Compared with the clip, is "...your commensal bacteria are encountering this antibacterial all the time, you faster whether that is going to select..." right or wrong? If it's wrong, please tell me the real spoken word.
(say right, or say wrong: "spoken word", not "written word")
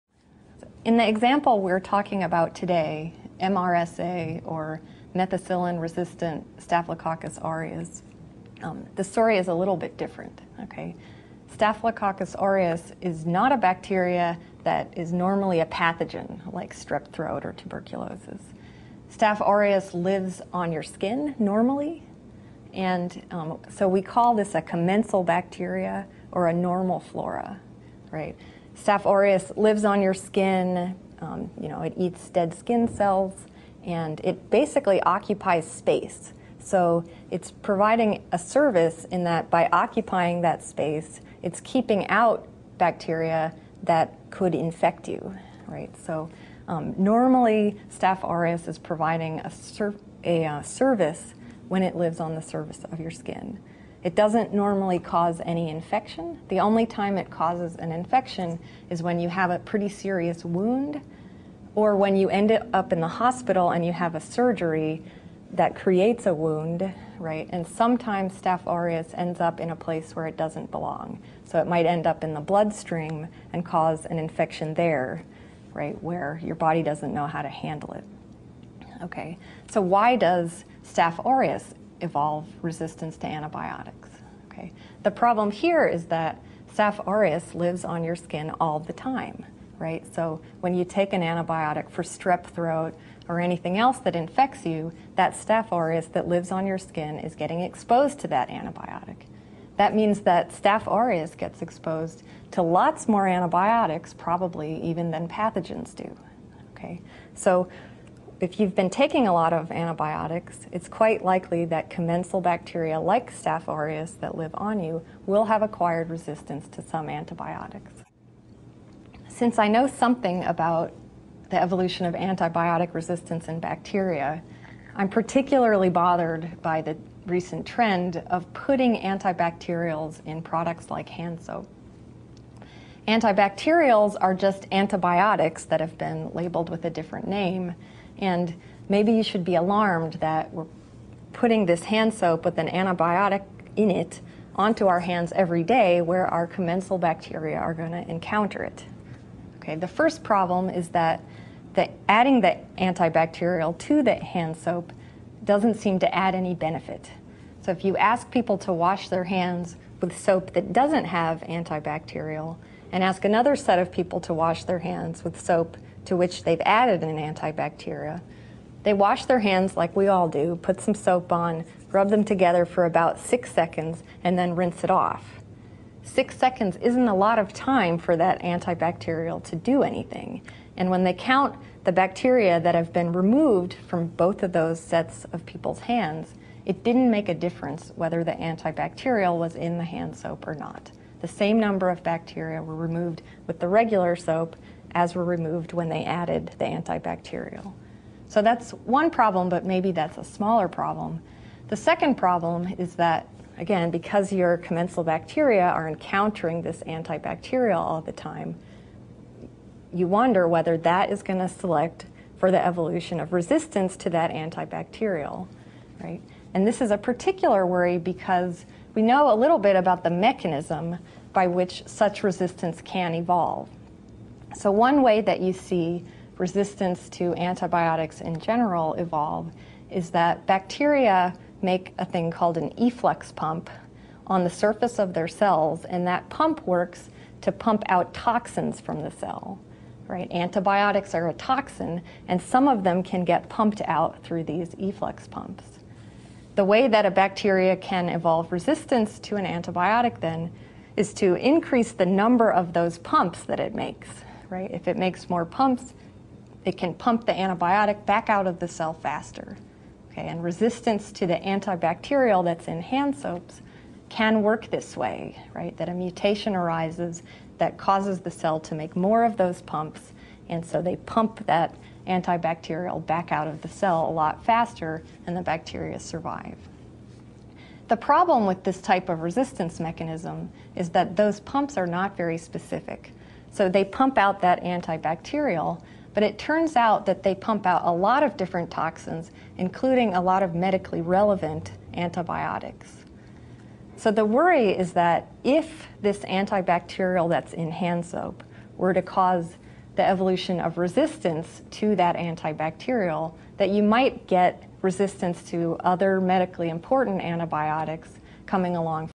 wrong: "wonder", not "faster".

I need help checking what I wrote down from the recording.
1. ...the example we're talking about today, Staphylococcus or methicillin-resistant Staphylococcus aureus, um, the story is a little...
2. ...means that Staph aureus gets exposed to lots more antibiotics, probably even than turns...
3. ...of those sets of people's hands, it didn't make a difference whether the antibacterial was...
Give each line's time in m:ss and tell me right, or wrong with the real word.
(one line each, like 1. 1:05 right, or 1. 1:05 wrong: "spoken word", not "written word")
1. 0:00 wrong: "MRSA", not "Staphylococcus"
2. 1:39 wrong: "pathogens", not "turns"
3. 3:04 right.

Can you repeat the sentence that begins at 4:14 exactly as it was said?
If it makes more pumps, it can pump the antibiotic back out of the cell faster.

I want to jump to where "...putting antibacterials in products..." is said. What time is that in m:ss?
2:08.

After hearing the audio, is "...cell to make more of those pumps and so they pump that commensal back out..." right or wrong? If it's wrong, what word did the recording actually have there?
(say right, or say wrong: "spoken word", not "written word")
wrong: "antibacterial", not "commensal".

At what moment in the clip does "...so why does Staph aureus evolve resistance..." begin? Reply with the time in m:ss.
1:19.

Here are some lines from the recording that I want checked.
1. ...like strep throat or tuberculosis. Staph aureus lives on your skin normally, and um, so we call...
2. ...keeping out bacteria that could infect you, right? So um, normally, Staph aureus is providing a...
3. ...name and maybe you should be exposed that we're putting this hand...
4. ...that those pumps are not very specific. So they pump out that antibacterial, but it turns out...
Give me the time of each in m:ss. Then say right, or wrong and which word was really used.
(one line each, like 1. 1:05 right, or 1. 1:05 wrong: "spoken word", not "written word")
1. 0:16 right
2. 0:41 right
3. 2:17 wrong: "alarmed", not "exposed"
4. 4:40 right.